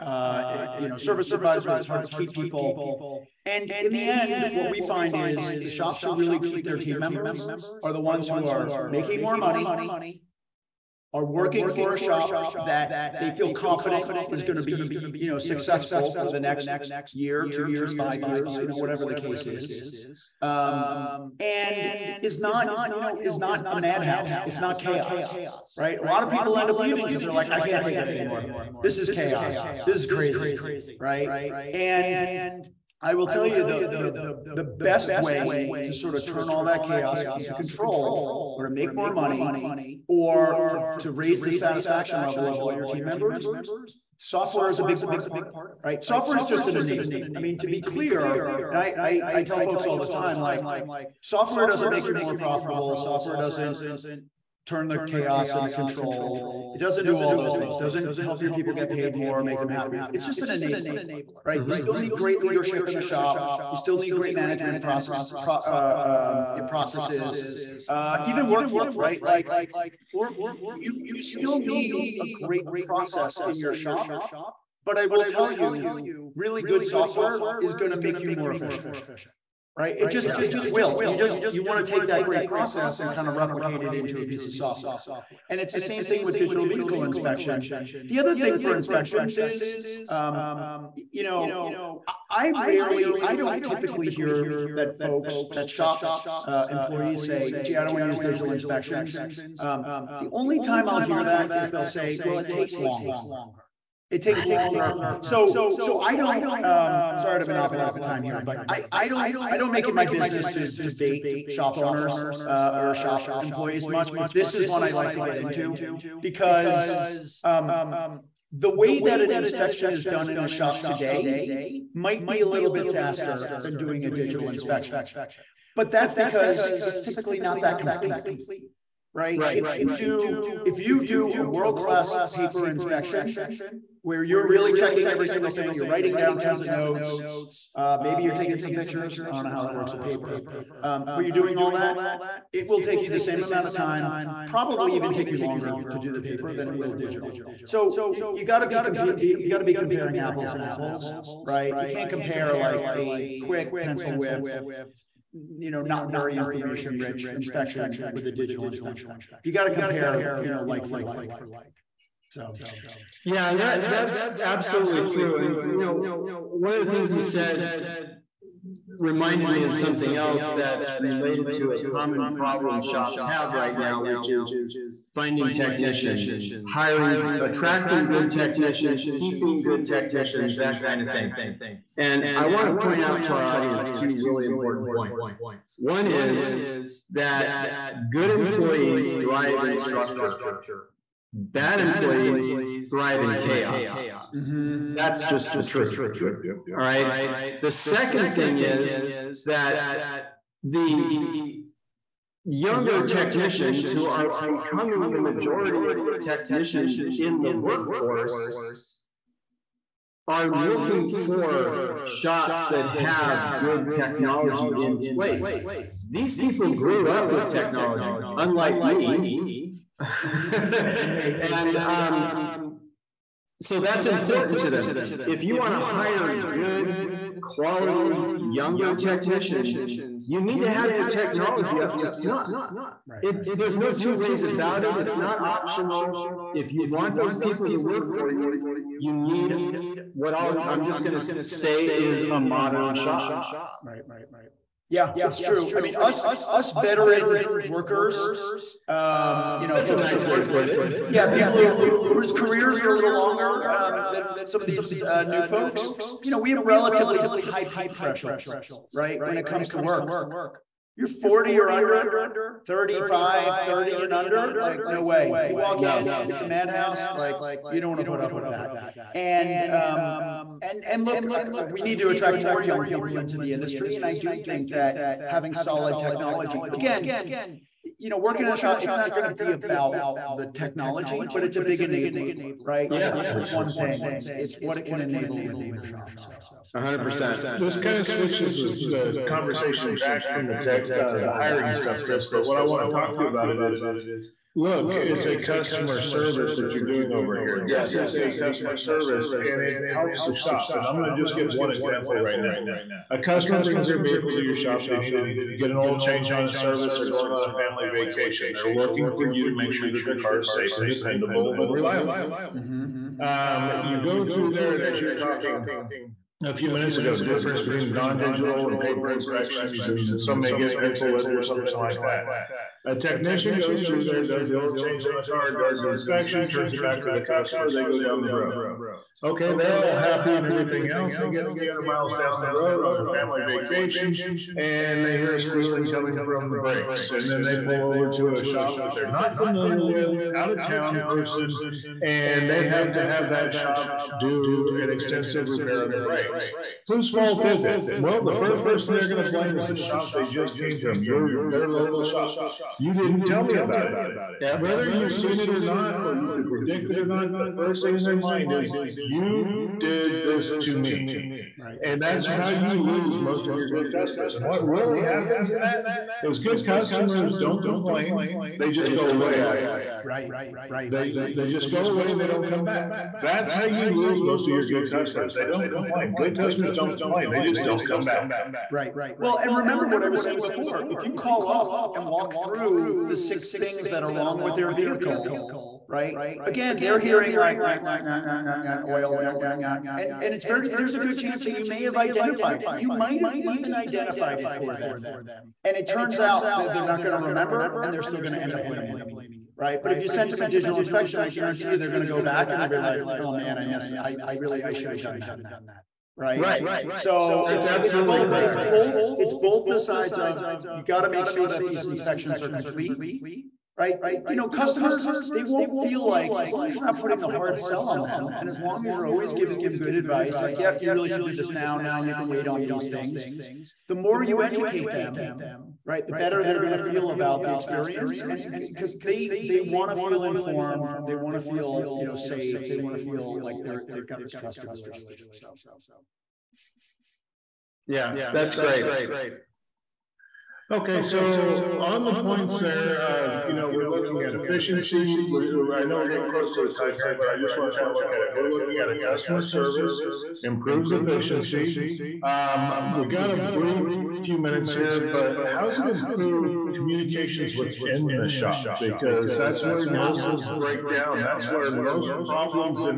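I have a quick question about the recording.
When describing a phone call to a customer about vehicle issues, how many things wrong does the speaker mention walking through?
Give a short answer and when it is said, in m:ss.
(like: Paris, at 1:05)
6, at 6:23.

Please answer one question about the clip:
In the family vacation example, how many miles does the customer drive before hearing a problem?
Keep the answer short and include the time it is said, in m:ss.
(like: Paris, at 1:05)
300, at 5:31.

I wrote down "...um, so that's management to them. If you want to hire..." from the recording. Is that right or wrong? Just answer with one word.
wrong.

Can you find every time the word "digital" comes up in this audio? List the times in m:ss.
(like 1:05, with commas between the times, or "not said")
1:26, 1:38, 2:04, 2:26, 2:38, 5:17, 6:40.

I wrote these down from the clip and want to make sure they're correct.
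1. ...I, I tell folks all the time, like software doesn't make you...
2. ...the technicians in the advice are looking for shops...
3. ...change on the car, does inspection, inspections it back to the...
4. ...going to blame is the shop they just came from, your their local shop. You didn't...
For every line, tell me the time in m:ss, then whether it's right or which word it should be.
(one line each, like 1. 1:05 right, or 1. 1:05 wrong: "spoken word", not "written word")
1. 0:49 right
2. 3:26 wrong: "workforce", not "advice"
3. 5:24 wrong: "turns", not "inspections"
4. 5:49 right.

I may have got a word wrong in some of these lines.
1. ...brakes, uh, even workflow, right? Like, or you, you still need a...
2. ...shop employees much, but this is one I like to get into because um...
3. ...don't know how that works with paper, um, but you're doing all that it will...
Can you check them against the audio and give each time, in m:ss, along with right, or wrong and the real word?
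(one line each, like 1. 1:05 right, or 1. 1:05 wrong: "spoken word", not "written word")
1. 1:06 wrong: "processes", not "brakes"
2. 1:52 right
3. 2:19 right.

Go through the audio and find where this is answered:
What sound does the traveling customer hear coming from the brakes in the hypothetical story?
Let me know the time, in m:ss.
5:35.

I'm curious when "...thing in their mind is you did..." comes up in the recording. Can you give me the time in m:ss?
5:57.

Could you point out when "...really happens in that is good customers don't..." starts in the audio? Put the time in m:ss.
6:04.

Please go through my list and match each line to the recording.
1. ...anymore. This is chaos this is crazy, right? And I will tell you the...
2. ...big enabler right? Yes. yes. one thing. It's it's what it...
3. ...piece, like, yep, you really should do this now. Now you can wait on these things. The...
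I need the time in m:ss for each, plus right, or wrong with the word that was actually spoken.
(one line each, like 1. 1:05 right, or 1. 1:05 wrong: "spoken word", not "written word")
1. 0:28 right
2. 4:41 right
3. 6:59 wrong: "advice", not "piece".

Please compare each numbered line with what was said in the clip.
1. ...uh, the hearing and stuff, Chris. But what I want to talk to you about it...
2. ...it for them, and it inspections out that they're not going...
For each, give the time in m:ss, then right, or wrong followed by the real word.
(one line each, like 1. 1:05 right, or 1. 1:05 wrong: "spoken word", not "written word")
1. 4:51 wrong: "hiring", not "hearing"
2. 6:34 wrong: "turns", not "inspections".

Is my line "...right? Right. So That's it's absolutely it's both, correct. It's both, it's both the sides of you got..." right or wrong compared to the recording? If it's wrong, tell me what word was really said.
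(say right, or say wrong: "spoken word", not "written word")
right.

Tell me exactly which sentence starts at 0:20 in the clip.
Um, and is not, you know, is not a madhouse.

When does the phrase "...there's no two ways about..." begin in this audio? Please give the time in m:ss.
3:53.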